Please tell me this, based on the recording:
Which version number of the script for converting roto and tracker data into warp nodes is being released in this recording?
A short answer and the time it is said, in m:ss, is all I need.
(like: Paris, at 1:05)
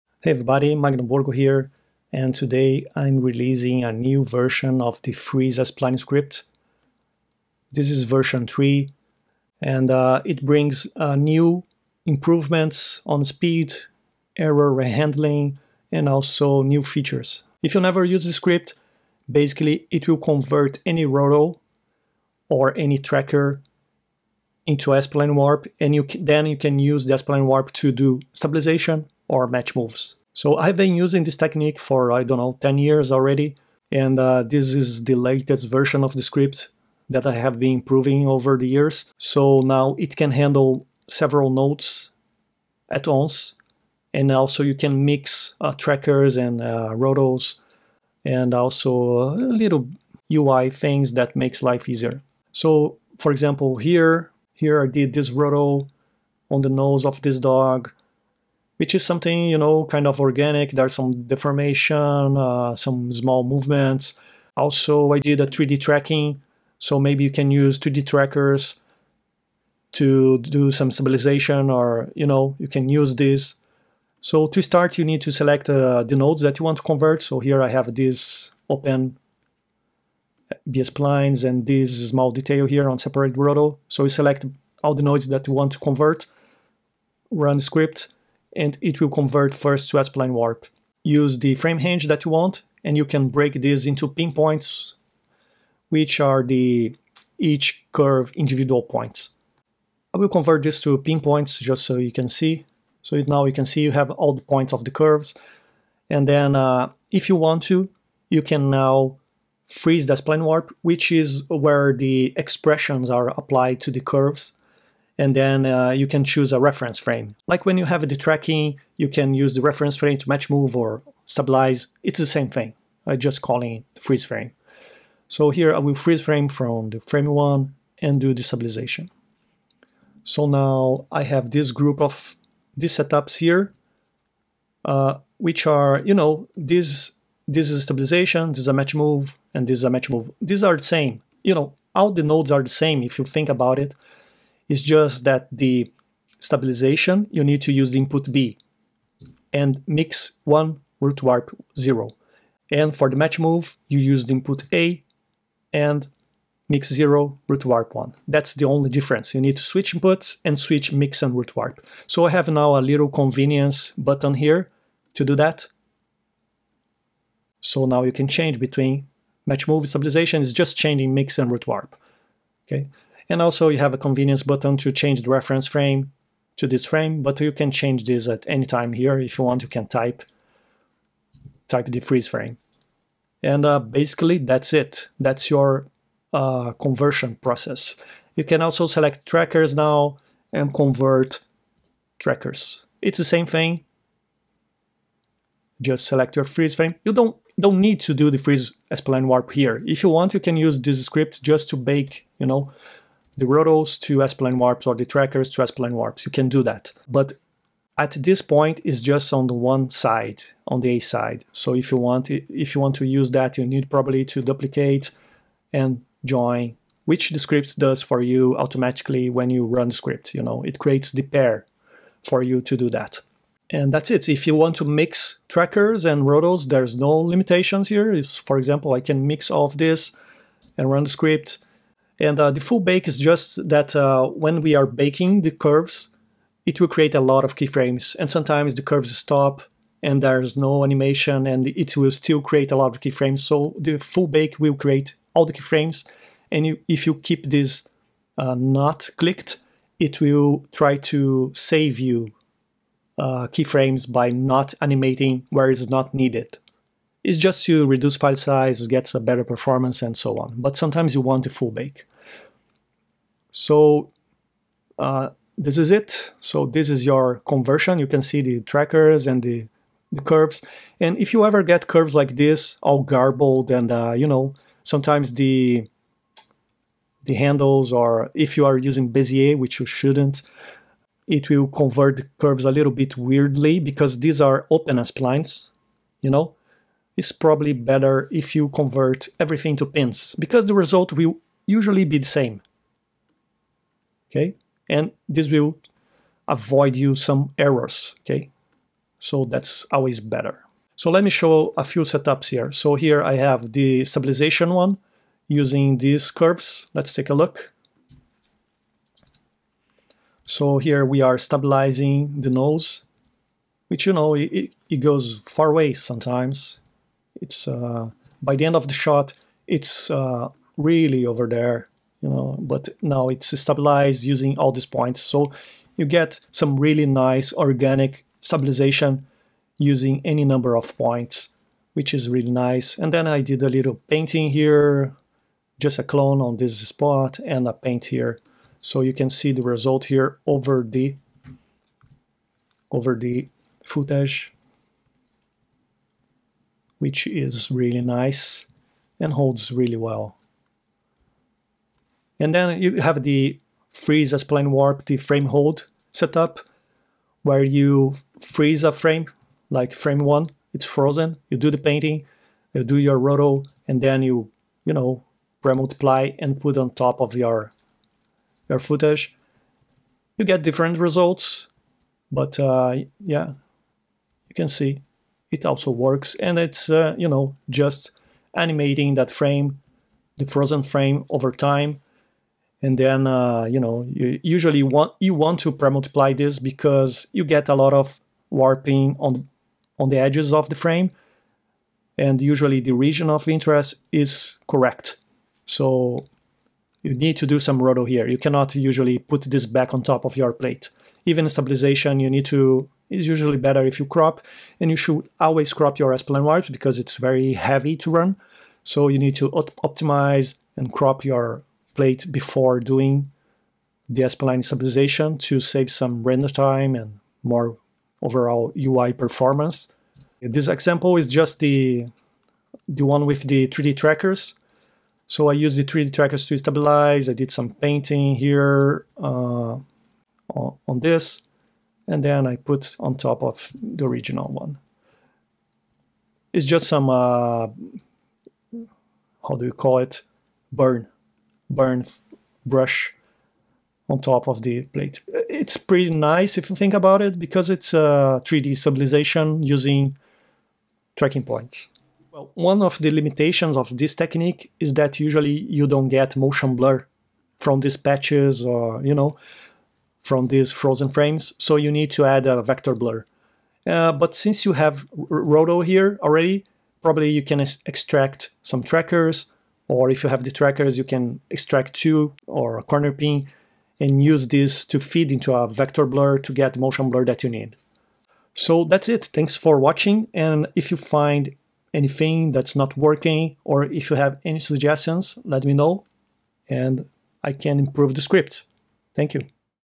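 3, at 0:08.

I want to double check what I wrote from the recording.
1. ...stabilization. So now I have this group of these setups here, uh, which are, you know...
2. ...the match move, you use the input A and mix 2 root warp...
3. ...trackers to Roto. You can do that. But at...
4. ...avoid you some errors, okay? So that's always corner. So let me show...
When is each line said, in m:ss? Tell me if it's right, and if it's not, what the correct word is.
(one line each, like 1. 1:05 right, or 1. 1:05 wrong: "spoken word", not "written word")
1. 2:08 right
2. 2:33 wrong: "0", not "2"
3. 3:25 wrong: "SplineWarps", not "Roto"
4. 4:56 wrong: "better", not "corner".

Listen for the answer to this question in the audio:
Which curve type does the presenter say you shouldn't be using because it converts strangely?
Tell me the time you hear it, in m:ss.
4:39.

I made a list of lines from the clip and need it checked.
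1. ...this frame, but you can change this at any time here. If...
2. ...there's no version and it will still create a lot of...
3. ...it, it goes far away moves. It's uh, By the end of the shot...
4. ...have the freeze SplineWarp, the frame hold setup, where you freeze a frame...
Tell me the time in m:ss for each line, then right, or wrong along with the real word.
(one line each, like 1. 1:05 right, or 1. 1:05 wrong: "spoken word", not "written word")
1. 2:56 right
2. 4:00 wrong: "animation", not "version"
3. 5:14 wrong: "sometimes", not "moves"
4. 5:53 right.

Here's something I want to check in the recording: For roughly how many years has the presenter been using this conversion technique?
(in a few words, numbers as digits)
10 years.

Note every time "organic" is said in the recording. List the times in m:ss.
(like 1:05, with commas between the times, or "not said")
1:00, 5:27.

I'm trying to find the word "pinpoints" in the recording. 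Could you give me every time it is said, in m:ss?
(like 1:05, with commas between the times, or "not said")
1:34, 1:40.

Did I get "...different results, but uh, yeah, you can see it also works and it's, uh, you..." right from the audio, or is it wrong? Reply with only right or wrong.
right.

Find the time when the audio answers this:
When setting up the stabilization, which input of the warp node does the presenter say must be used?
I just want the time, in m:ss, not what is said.
2:27.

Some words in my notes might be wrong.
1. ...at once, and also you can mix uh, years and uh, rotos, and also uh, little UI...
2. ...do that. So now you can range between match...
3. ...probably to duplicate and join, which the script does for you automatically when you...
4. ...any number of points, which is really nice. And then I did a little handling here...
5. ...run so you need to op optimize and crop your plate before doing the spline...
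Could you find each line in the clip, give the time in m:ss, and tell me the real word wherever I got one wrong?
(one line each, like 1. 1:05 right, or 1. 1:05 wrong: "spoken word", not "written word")
1. 0:42 wrong: "trackers", not "years"
2. 2:45 wrong: "change", not "range"
3. 3:33 right
4. 5:30 wrong: "painting", not "handling"
5. 6:48 right.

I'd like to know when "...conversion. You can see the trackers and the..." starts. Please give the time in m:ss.
4:27.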